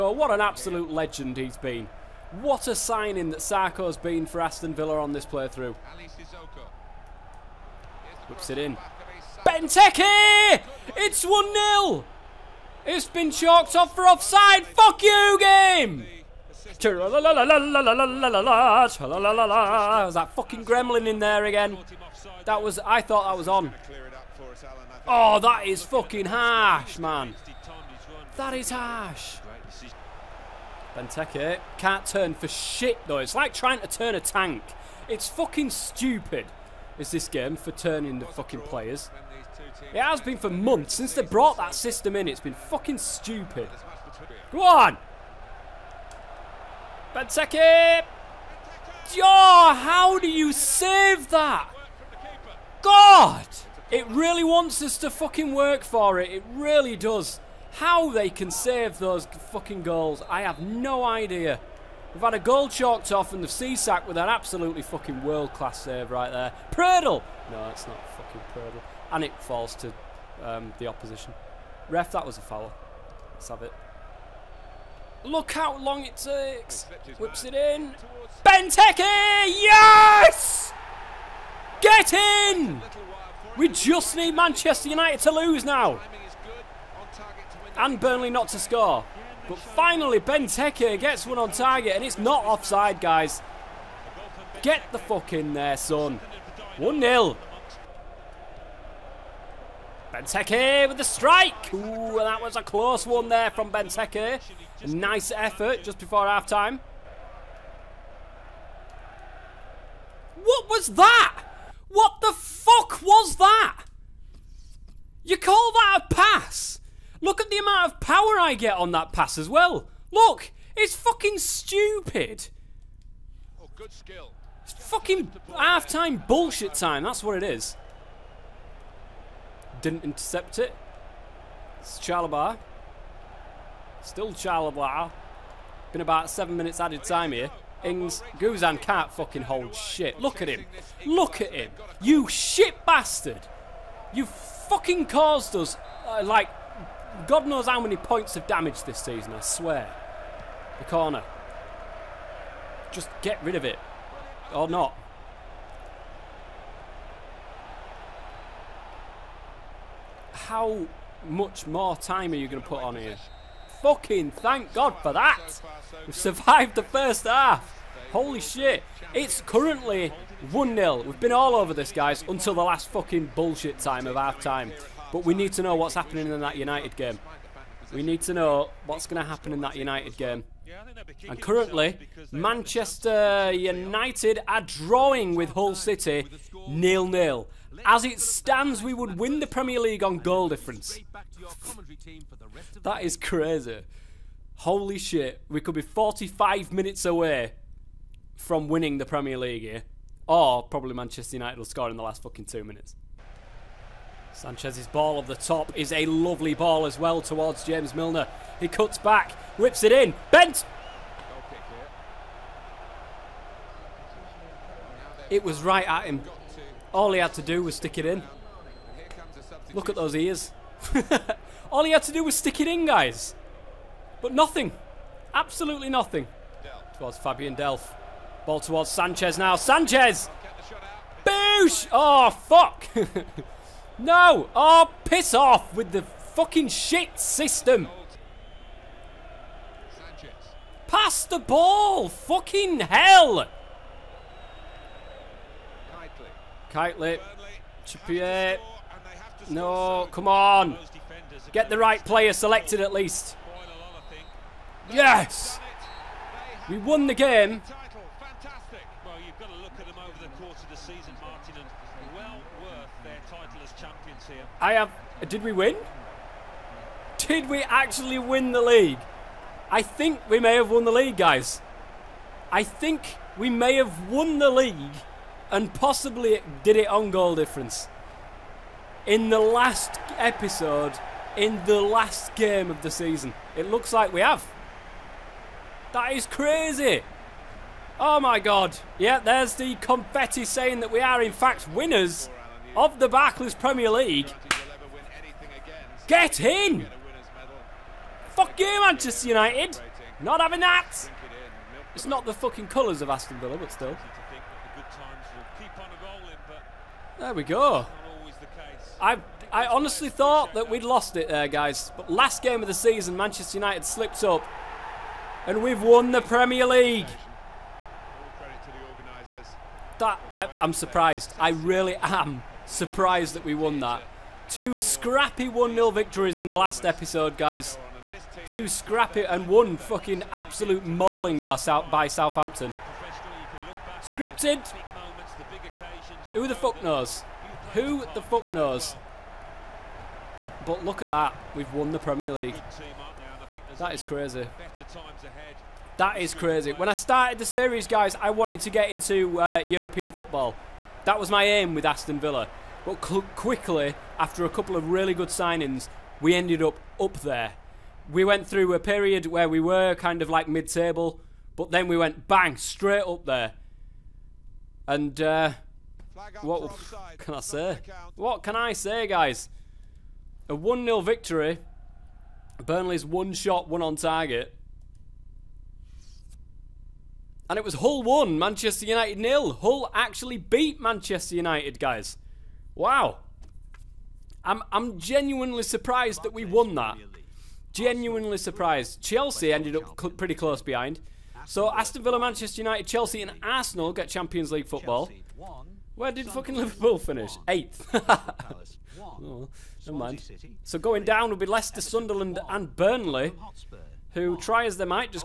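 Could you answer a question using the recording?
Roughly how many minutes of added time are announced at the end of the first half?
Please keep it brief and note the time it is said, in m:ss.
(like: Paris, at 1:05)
7, at 2:16.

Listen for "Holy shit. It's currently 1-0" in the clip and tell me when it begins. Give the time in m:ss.
2:48.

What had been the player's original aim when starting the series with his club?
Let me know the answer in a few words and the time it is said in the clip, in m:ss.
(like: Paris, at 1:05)
European football, at 5:49.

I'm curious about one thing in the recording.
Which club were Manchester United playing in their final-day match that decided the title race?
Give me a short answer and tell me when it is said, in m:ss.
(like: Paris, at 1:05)
Hull City, at 3:05.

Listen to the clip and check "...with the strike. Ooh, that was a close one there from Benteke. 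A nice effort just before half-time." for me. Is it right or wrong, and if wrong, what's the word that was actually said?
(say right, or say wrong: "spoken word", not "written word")
right.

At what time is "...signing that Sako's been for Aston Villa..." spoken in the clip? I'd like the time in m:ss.
0:02.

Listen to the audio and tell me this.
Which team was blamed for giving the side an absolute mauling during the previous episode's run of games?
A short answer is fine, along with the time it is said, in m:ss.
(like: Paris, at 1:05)
Southampton, at 5:32.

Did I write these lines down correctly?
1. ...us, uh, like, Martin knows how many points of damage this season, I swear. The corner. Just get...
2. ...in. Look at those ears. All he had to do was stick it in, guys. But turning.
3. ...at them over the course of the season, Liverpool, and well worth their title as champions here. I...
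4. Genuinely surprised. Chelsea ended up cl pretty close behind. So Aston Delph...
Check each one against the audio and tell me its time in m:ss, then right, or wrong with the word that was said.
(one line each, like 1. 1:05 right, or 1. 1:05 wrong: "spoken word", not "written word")
1. 2:25 wrong: "God", not "Martin"
2. 3:38 wrong: "nothing", not "turning"
3. 4:19 wrong: "Martin", not "Liverpool"
4. 6:27 wrong: "Villa", not "Delph".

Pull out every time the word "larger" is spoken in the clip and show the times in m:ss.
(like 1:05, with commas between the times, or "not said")
not said.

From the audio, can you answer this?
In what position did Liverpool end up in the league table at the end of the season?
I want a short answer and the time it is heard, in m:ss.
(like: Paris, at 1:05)
Eighth, at 6:37.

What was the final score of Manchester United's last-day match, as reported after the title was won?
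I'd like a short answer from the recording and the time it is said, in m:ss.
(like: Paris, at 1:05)
Hull 1, Manchester United 0, at 6:17.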